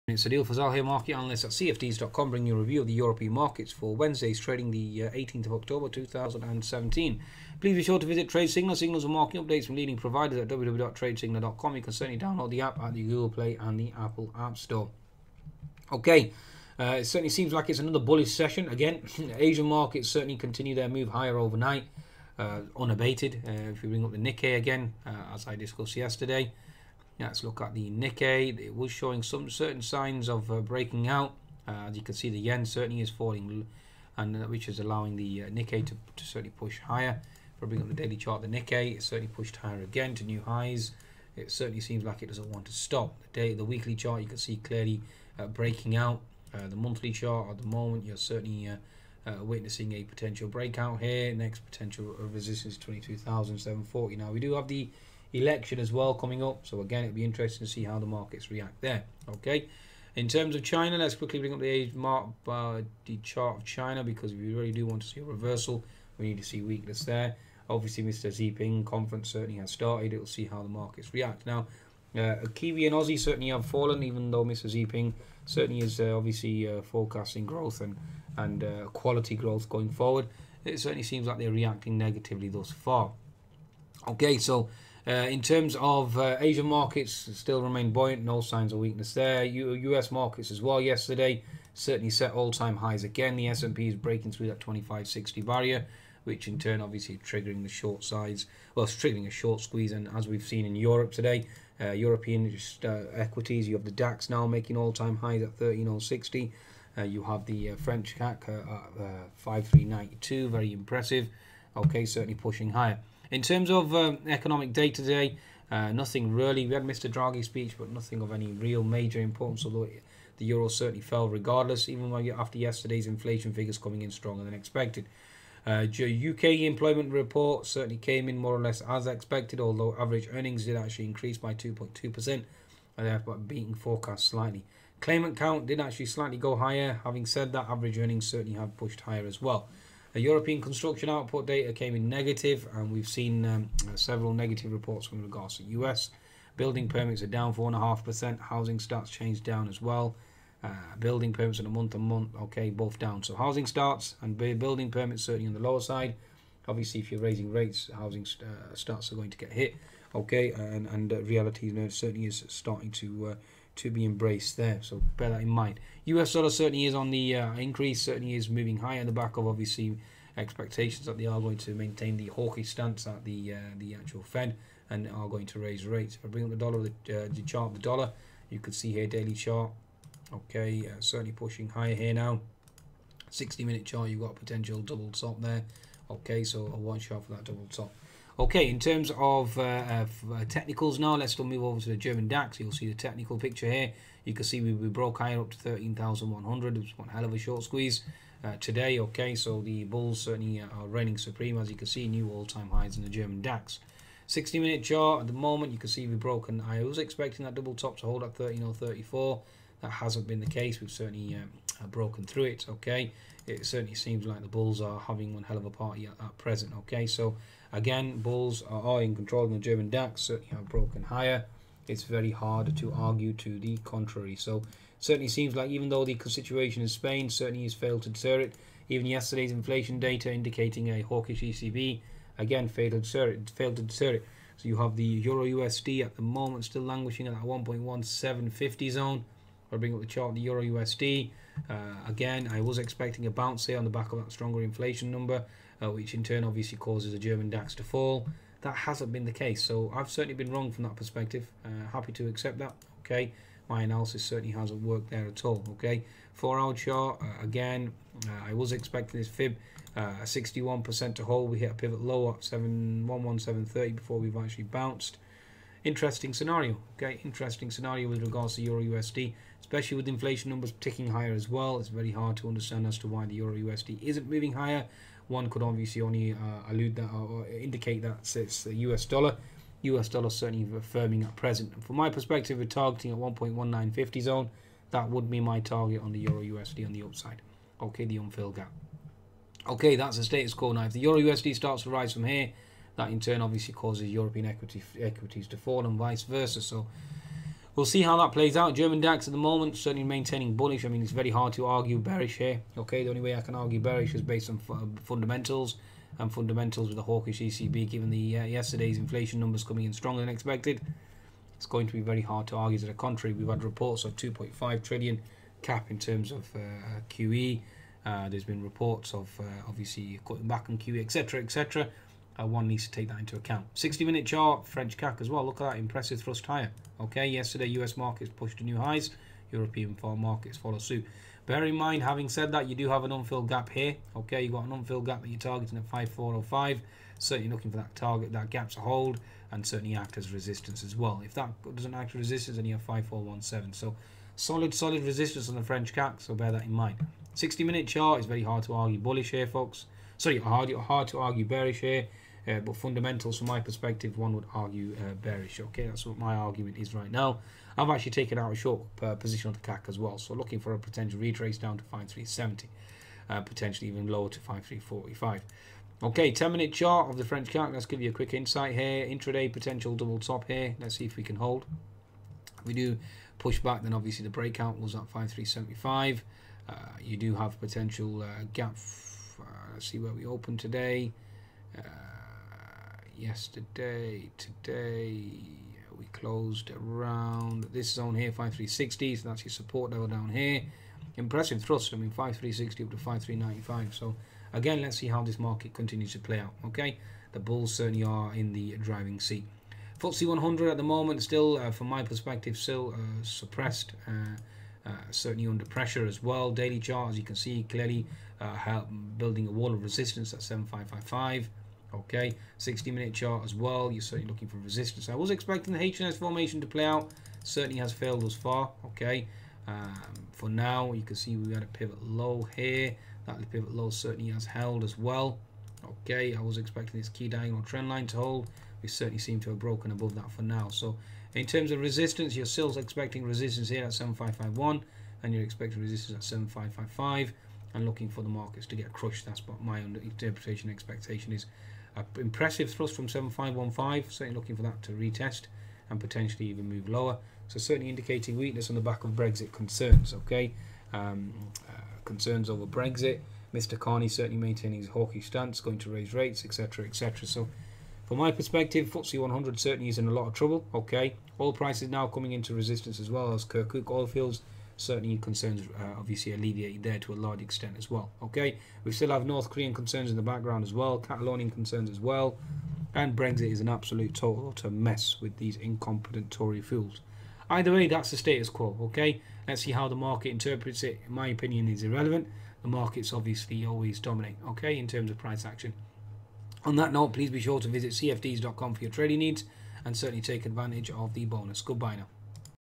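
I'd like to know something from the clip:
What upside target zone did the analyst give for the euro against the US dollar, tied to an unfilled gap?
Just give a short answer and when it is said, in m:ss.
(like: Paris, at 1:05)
1.1950, at 4:43.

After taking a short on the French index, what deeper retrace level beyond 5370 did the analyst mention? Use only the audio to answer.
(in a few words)
5345.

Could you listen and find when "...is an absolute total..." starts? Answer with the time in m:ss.
7:53.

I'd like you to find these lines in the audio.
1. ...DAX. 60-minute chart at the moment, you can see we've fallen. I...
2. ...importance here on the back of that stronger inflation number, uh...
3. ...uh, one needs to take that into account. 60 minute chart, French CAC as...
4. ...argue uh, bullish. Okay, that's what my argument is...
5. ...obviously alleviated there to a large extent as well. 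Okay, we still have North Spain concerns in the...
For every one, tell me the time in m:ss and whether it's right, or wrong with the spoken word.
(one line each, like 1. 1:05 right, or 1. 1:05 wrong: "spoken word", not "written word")
1. 3:23 wrong: "broken", not "fallen"
2. 4:03 wrong: "bounce", not "importance"
3. 5:22 right
4. 5:54 wrong: "bearish", not "bullish"
5. 7:45 wrong: "Korean", not "Spain".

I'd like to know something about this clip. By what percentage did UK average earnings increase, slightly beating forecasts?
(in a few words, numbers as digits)
2.2%.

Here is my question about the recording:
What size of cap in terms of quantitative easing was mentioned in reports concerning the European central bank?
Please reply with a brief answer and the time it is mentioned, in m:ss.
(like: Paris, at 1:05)
2.5 trillion, at 5:14.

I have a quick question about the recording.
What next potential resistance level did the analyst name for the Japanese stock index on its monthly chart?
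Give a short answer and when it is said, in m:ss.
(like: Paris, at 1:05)
22,740, at 0:52.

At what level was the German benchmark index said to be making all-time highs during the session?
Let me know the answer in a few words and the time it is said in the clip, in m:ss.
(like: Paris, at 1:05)
13060, at 1:45.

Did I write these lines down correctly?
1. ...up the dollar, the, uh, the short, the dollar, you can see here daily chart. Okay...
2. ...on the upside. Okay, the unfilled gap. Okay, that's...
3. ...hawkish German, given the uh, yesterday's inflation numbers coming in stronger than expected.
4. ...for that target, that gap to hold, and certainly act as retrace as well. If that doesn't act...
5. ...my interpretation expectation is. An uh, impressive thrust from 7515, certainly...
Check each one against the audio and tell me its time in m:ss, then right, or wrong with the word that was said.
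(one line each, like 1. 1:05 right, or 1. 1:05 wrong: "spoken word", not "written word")
1. 2:56 wrong: "chart", not "short"
2. 4:46 right
3. 5:07 wrong: "ECB", not "German"
4. 5:37 wrong: "resistance", not "retrace"
5. 7:19 right.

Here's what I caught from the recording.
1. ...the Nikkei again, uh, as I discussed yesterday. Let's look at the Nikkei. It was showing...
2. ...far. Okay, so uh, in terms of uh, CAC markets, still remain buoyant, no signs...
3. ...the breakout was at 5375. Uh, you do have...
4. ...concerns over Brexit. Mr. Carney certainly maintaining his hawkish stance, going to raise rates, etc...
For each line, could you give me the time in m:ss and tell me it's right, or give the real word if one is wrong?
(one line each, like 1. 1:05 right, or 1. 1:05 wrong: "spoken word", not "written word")
1. 0:24 right
2. 1:22 wrong: "Asian", not "CAC"
3. 6:14 right
4. 7:32 right.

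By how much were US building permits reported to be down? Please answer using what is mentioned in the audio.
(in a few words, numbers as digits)
4.5%.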